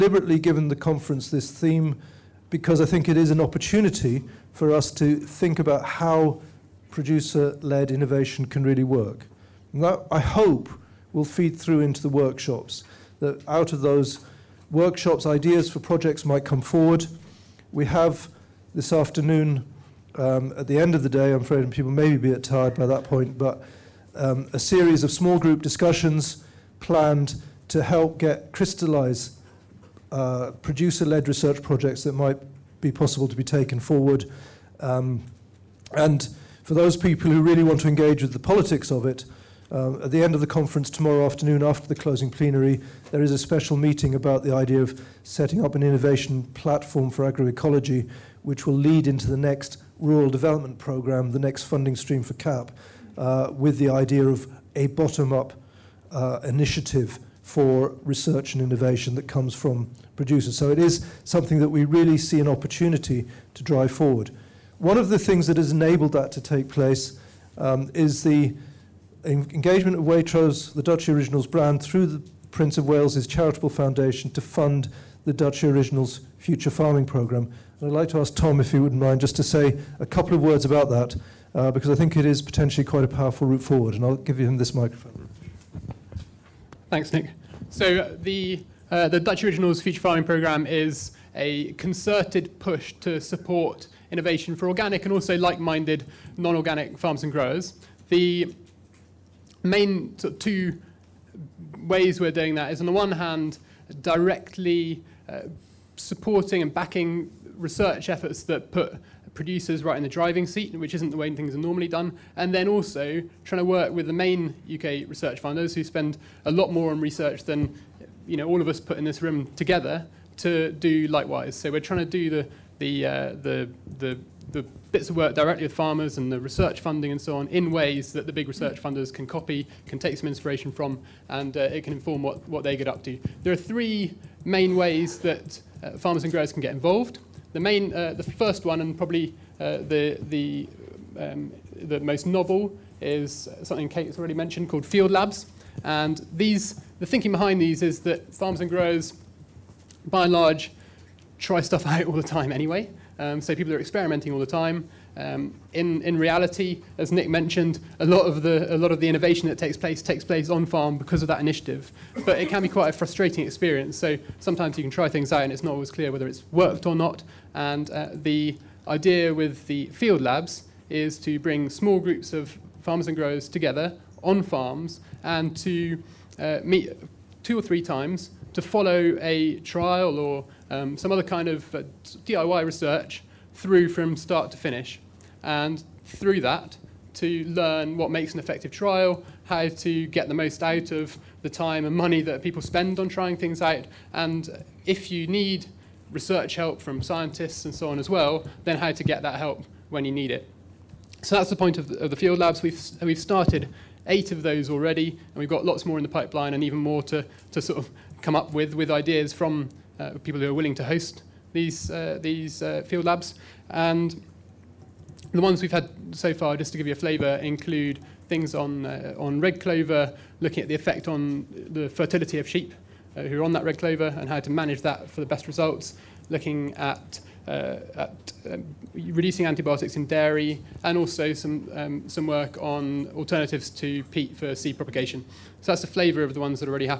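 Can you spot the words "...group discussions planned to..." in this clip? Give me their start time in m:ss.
0:25.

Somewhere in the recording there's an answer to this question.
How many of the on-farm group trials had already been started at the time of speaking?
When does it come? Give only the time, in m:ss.
3:24.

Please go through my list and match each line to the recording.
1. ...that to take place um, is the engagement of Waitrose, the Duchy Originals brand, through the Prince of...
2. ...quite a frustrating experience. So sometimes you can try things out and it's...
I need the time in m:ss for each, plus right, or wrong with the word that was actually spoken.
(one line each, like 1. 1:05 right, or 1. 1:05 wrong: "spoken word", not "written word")
1. 1:06 right
2. 2:42 right.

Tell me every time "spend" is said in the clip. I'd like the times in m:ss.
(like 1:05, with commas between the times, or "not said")
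1:55, 3:12.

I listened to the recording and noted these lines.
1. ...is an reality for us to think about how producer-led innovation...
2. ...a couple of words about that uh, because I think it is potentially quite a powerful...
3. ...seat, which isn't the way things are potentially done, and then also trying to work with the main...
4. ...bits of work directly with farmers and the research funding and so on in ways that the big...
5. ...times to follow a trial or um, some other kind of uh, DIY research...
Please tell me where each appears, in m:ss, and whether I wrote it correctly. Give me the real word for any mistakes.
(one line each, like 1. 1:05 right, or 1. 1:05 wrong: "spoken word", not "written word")
1. 0:03 wrong: "opportunity", not "reality"
2. 1:19 right
3. 1:50 wrong: "normally", not "potentially"
4. 2:04 right
5. 2:57 right.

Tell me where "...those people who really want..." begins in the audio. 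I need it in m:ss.
0:36.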